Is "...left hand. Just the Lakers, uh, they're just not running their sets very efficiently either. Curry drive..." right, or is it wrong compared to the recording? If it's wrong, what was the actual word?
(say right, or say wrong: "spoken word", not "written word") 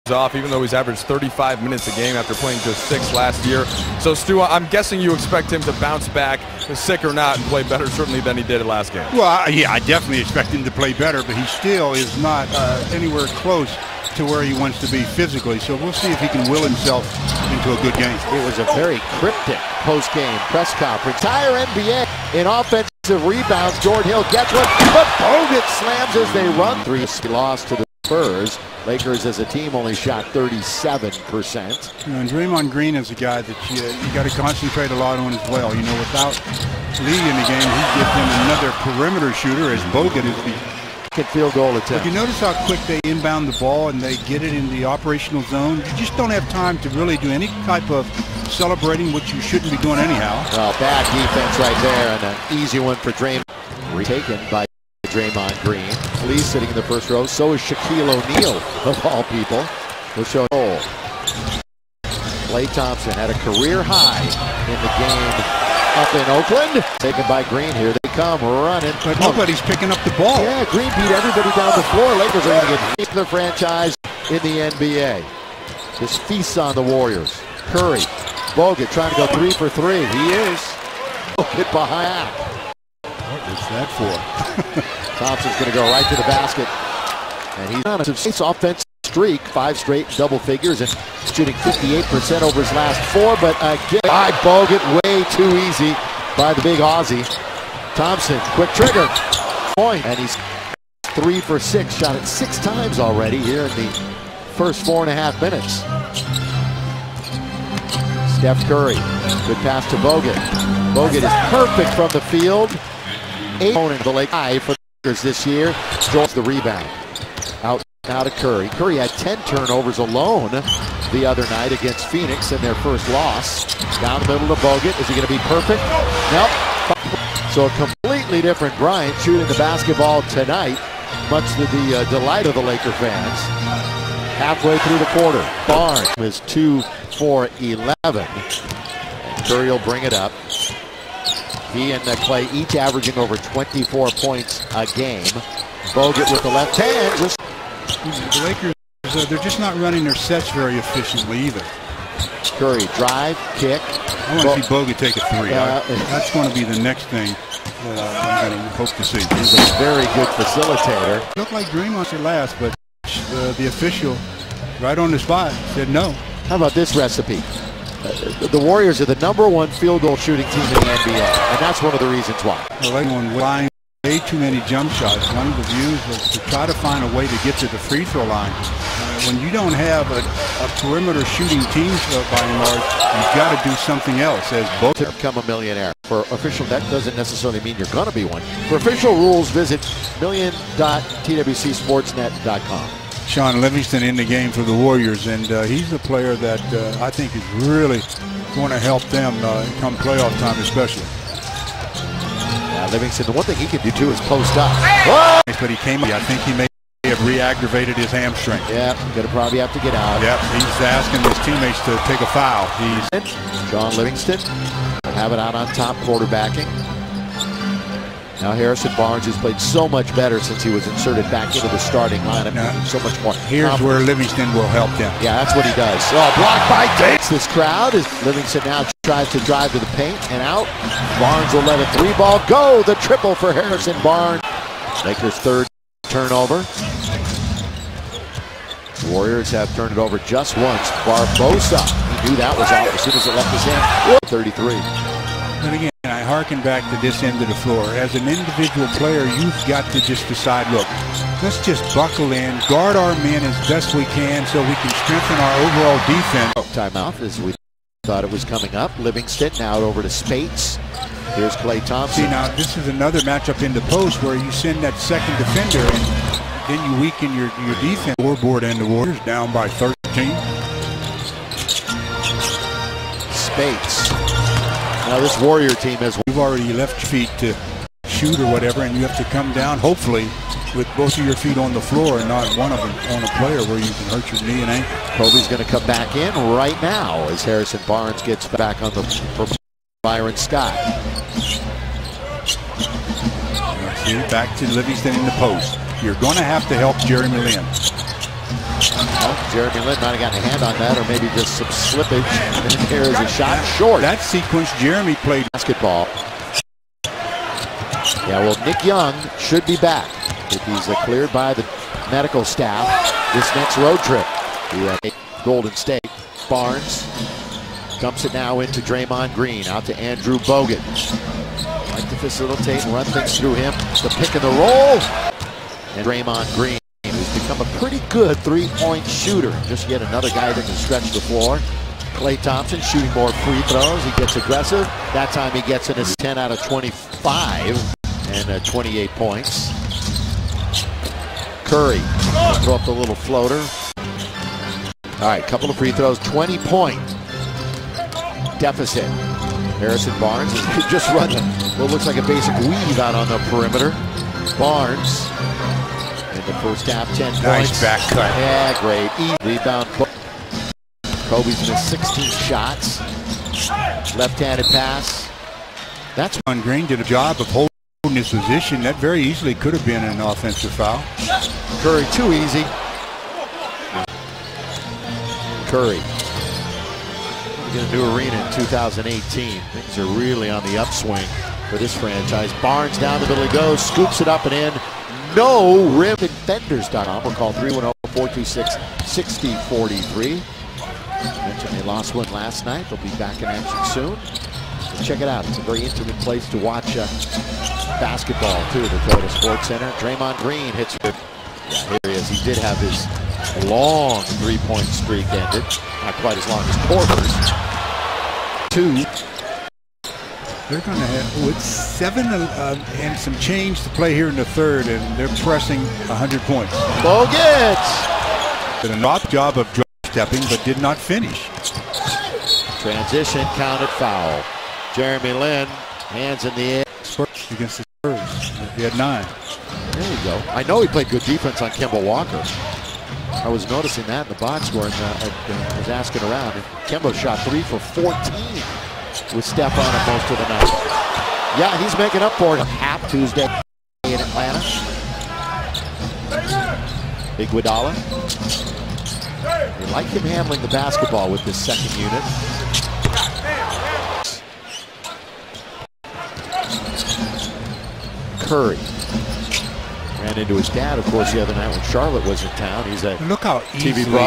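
right.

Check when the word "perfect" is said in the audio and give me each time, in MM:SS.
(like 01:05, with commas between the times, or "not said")
01:51, 02:05.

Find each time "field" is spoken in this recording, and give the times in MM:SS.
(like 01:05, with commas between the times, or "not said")
00:41, 01:52, 02:49.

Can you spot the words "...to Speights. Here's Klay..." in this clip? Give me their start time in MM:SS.
04:20.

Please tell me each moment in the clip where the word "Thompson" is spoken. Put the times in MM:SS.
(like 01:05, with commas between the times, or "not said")
01:02, 01:25, 01:37, 04:21, 05:32.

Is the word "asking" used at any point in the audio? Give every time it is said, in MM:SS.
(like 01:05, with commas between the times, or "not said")
03:30, 07:15.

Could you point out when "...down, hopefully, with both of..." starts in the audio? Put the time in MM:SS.
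04:39.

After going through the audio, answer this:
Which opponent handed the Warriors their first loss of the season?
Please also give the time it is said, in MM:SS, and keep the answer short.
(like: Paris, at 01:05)
Phoenix, at 02:02.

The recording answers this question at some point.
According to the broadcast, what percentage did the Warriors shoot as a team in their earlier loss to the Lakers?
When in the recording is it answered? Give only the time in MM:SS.
00:30.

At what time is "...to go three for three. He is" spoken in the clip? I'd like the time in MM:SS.
01:19.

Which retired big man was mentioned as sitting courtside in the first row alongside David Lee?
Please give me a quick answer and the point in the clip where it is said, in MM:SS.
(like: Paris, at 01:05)
Shaquille O'Neal, at 00:57.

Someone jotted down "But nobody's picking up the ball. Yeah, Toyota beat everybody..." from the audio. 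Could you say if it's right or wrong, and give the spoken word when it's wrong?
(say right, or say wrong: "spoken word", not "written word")
wrong: "Green", not "Toyota".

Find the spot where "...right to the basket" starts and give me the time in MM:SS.
01:25.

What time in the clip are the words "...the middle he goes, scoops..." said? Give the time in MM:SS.
06:23.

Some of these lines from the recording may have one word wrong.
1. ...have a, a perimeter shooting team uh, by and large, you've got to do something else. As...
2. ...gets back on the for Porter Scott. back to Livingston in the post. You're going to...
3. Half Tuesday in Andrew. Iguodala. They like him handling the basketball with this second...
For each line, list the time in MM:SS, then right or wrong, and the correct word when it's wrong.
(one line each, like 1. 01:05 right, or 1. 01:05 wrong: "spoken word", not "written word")
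1. 02:59 right
2. 04:48 wrong: "Byron", not "Porter"
3. 07:22 wrong: "Atlanta", not "Andrew".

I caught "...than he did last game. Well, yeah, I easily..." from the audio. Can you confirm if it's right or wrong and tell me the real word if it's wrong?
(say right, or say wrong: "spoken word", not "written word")
wrong: "definitely", not "easily".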